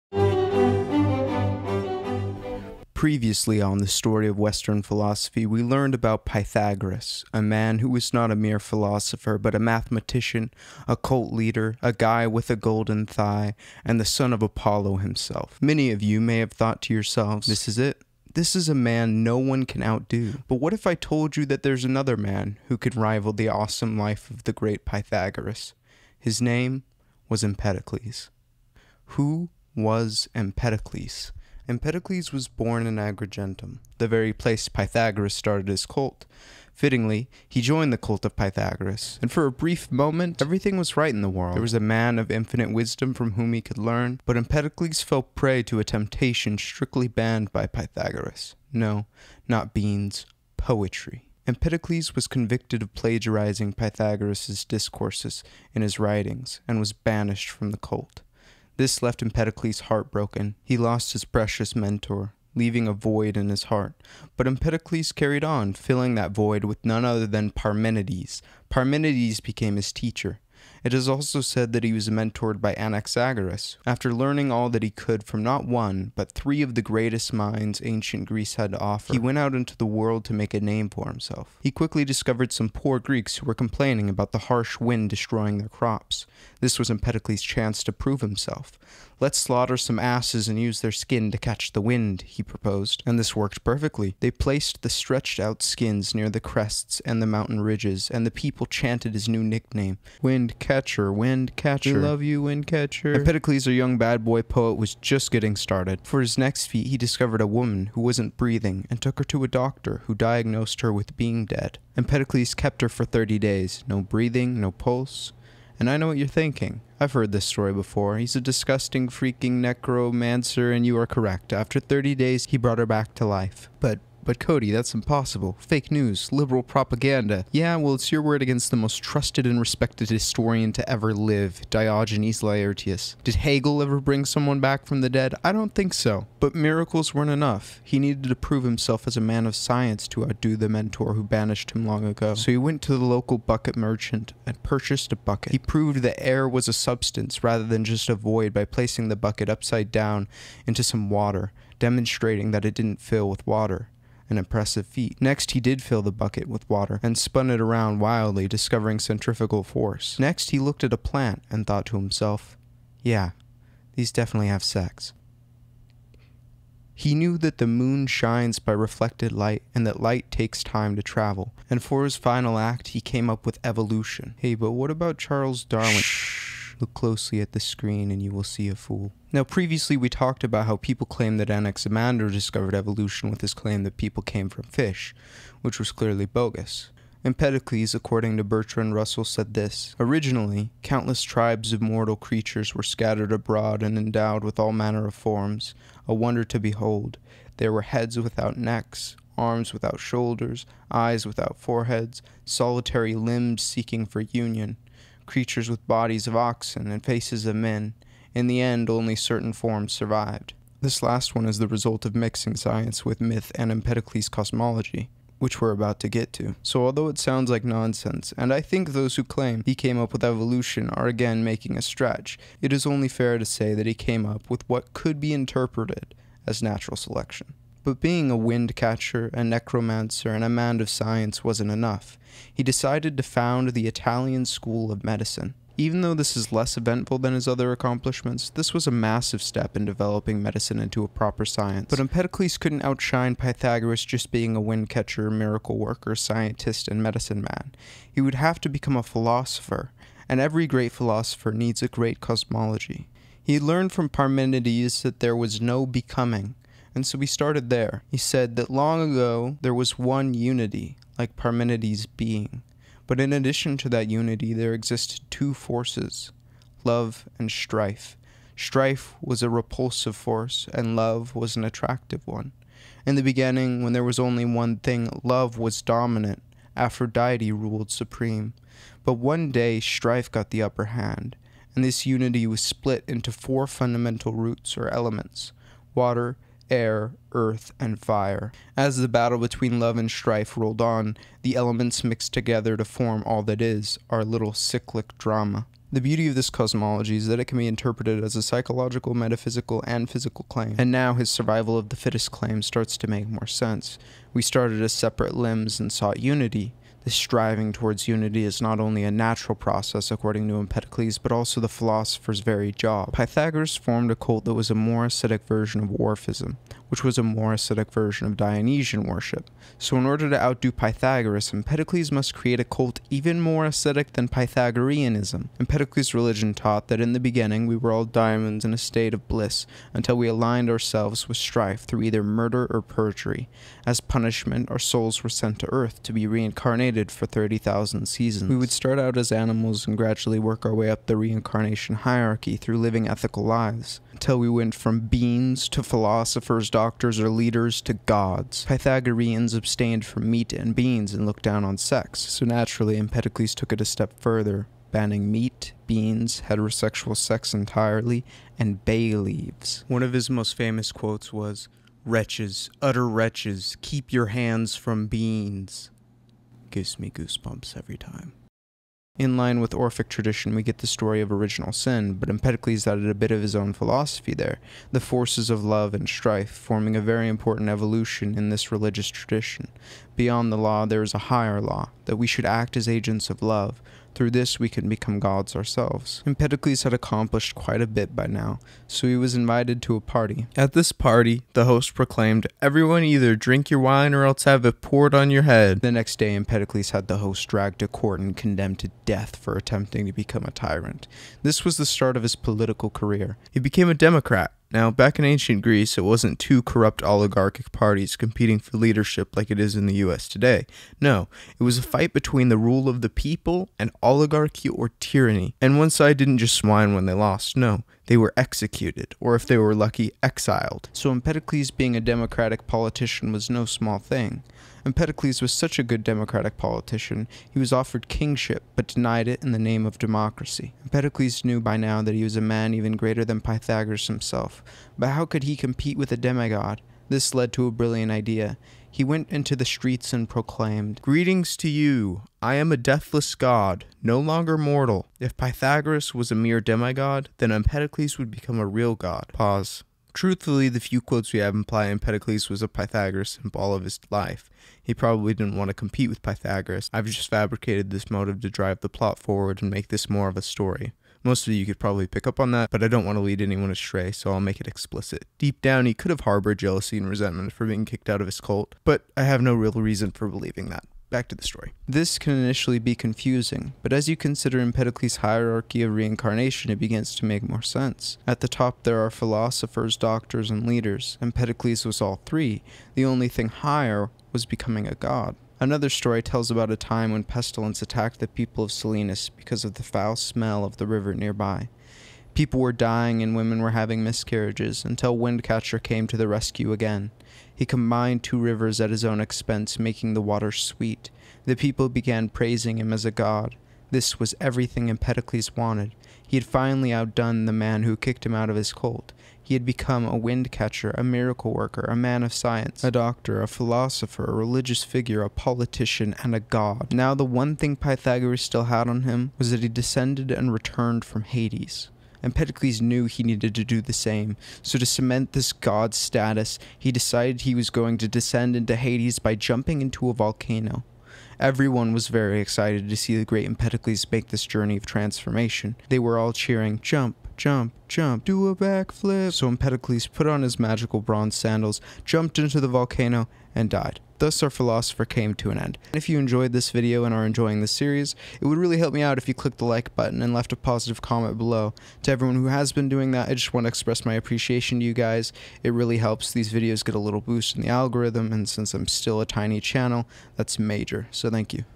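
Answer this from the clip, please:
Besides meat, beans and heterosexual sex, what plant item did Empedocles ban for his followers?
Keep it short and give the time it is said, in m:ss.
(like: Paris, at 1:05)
Bay leaves, at 5:58.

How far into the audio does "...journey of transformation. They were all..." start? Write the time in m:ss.
8:54.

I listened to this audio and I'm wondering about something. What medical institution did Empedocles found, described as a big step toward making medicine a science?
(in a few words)
Italian School of Medicine.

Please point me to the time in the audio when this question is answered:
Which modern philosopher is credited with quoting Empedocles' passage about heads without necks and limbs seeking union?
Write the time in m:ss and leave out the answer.
3:08.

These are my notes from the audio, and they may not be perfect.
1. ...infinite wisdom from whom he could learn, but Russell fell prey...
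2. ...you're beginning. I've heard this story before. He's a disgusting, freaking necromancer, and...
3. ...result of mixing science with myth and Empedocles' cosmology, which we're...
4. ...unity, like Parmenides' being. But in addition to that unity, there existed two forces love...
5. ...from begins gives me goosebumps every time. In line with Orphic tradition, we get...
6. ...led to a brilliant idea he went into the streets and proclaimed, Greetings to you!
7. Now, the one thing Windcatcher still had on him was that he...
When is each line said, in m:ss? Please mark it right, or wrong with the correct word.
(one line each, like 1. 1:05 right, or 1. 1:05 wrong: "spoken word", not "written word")
1. 0:42 wrong: "Empedocles", not "Russell"
2. 1:56 wrong: "thinking", not "beginning"
3. 3:31 right
4. 4:20 right
5. 6:04 wrong: "beans", not "begins"
6. 7:17 right
7. 8:36 wrong: "Pythagoras", not "Windcatcher".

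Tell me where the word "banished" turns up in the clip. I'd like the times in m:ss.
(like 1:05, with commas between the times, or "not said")
0:56, 2:21.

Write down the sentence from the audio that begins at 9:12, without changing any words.
To everyone who has been doing that, I just want to express my appreciation to you guys.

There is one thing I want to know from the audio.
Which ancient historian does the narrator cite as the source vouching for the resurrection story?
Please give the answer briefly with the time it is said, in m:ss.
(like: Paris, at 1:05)
Diogenes Laertius, at 2:11.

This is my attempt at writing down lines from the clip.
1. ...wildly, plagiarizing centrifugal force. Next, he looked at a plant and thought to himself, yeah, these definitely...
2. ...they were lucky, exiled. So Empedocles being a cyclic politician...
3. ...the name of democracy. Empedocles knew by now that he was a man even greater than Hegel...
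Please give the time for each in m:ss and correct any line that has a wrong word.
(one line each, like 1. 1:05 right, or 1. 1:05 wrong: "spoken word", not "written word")
1. 2:37 wrong: "discovering", not "plagiarizing"
2. 6:59 wrong: "democratic", not "cyclic"
3. 7:09 wrong: "Pythagoras", not "Hegel".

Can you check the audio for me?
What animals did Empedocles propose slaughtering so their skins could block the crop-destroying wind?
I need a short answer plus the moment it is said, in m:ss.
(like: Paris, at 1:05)
Asses, at 1:29.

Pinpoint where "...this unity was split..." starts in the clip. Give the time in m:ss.
4:41.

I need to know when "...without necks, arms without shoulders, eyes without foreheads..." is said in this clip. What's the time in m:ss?
3:18.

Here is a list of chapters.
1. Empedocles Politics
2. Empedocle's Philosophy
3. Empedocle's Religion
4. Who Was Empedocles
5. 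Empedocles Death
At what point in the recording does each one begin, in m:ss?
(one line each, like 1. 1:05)
1. 6:27
2. 4:07
3. 5:01
4. 0:28
5. 8:08.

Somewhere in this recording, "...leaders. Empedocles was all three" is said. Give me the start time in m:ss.
8:00.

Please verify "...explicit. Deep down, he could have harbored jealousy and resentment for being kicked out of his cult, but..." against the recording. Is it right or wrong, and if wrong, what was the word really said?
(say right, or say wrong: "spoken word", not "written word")
right.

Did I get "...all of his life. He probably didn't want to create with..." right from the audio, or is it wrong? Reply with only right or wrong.
wrong.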